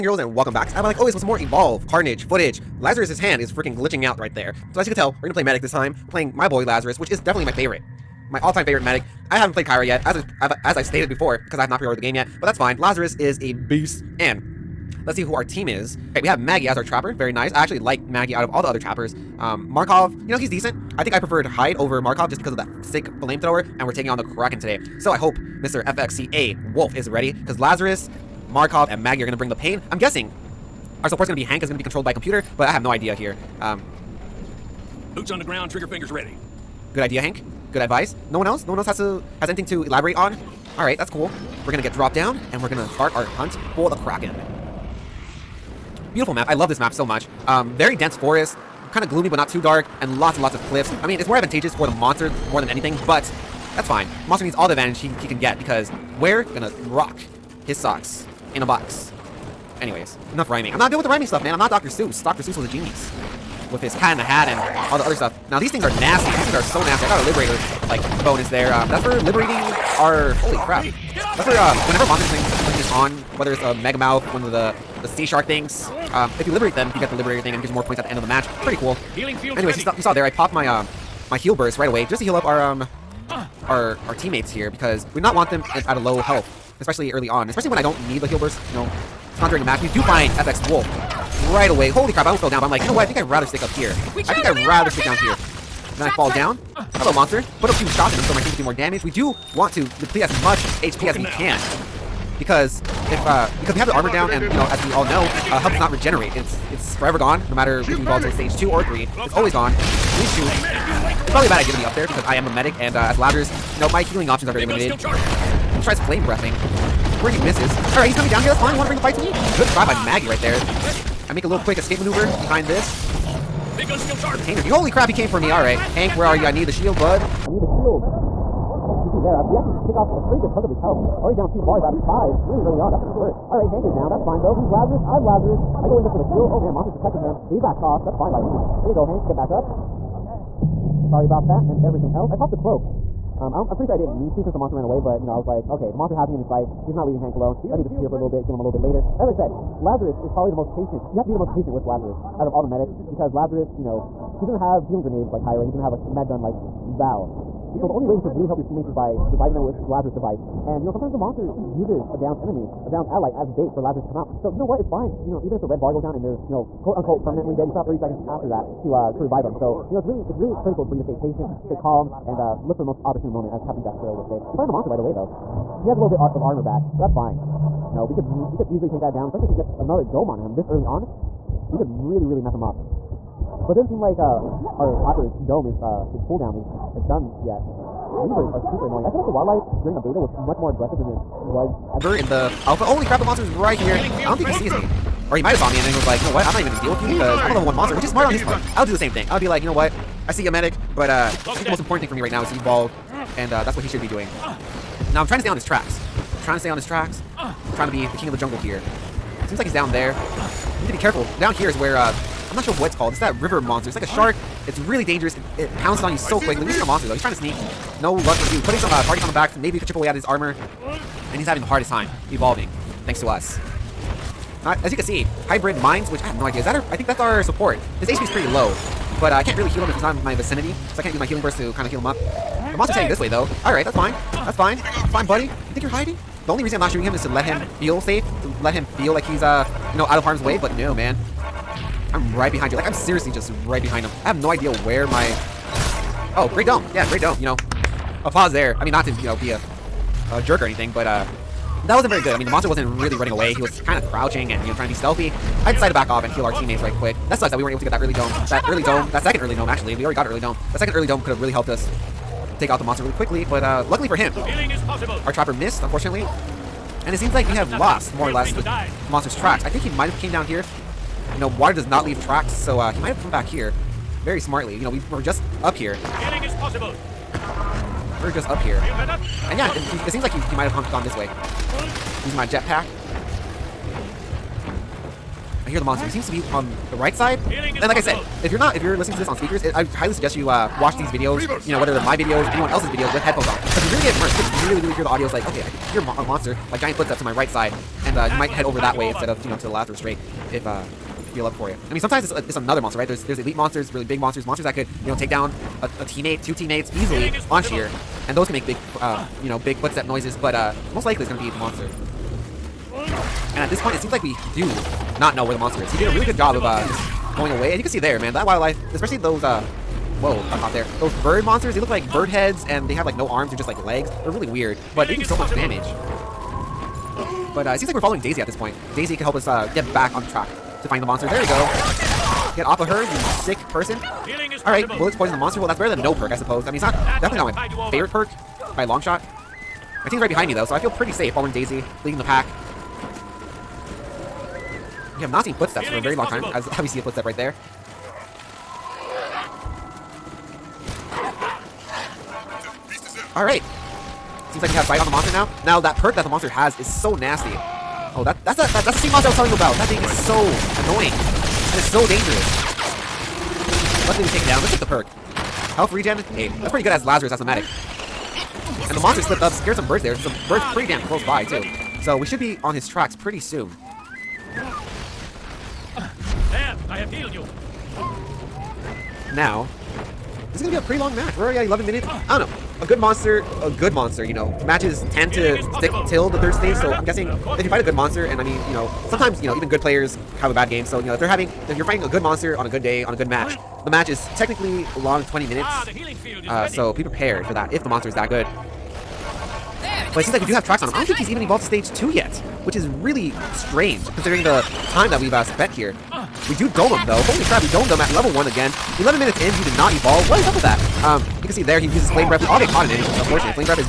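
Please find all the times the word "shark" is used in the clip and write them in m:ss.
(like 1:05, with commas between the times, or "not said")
1:15, 3:34.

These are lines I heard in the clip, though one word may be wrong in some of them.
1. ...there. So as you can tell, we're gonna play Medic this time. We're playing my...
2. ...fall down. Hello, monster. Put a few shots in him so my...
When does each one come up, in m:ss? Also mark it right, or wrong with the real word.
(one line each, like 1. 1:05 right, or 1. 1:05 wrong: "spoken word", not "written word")
1. 0:04 right
2. 1:36 right.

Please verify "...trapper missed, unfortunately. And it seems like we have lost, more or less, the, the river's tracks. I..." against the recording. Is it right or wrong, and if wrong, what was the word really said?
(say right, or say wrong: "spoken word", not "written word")
wrong: "monster", not "river".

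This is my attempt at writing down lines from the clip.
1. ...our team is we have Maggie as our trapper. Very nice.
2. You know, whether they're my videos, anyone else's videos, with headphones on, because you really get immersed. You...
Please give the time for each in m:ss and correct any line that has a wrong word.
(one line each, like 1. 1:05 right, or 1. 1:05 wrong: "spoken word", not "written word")
1. 0:15 right
2. 4:51 right.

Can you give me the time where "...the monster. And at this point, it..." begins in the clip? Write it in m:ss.
5:11.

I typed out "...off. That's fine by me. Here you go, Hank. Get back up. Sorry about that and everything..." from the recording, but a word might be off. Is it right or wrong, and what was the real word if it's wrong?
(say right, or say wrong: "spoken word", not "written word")
right.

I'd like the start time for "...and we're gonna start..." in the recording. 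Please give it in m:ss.
0:42.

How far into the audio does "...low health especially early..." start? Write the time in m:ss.
1:25.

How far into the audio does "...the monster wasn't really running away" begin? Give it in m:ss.
4:12.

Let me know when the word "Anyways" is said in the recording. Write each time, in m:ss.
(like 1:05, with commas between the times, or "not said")
0:59, 1:19.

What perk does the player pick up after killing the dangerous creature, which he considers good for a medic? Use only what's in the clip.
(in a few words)
Health regen.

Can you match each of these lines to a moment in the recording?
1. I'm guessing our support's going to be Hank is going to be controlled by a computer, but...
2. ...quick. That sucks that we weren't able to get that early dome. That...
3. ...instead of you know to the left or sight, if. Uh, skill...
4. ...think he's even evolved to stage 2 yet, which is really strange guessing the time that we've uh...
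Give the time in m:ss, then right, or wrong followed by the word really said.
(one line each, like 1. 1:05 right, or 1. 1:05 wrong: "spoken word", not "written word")
1. 0:29 right
2. 4:17 right
3. 4:59 wrong: "straight", not "sight"
4. 6:41 wrong: "considering", not "guessing".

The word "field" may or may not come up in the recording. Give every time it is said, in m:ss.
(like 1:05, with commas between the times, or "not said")
1:19.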